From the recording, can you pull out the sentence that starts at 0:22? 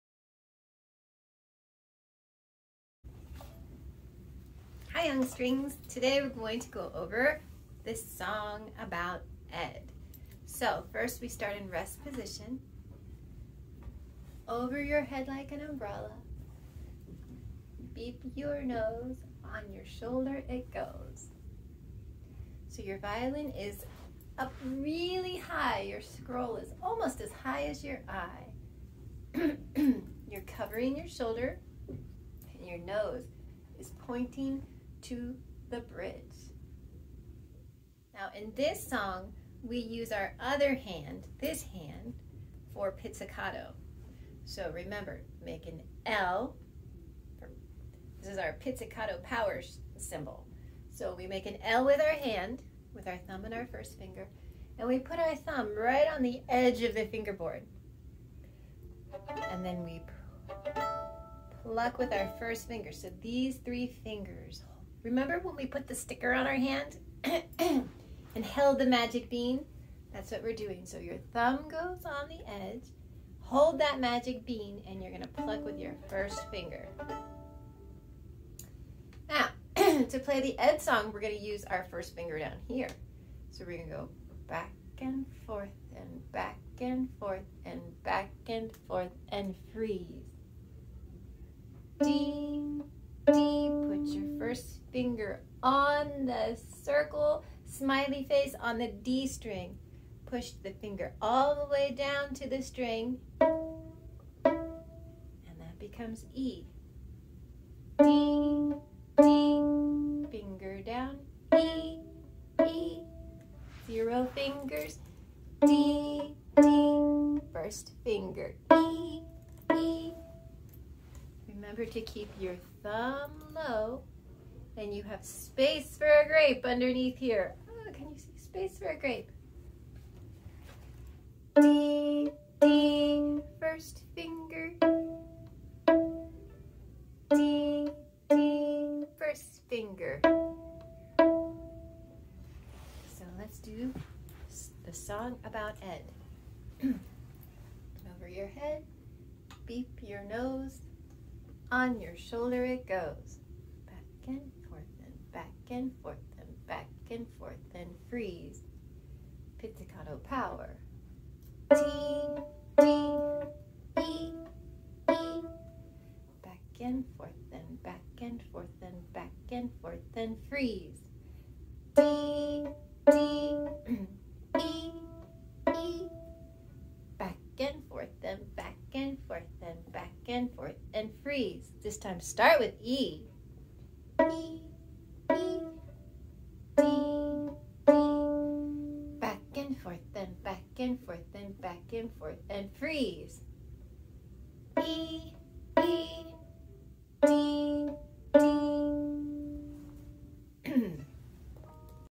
So your violin is up really high.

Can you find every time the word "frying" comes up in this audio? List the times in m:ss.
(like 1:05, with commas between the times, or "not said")
not said.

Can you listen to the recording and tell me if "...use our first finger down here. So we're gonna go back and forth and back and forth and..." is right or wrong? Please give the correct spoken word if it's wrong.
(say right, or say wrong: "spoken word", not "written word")
right.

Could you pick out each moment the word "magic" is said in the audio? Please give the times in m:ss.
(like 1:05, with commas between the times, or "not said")
1:08, 1:13.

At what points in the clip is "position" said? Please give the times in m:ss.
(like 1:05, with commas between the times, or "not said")
0:12.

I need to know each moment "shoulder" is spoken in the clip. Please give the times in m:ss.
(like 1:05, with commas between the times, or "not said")
0:19, 0:31, 2:32.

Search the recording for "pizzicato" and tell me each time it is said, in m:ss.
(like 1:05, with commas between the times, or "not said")
0:42, 0:48, 2:39.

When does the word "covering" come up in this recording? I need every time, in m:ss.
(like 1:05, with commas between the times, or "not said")
0:30.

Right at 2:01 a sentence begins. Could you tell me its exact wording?
Remember to keep your thumb low and you have space for a grape underneath here.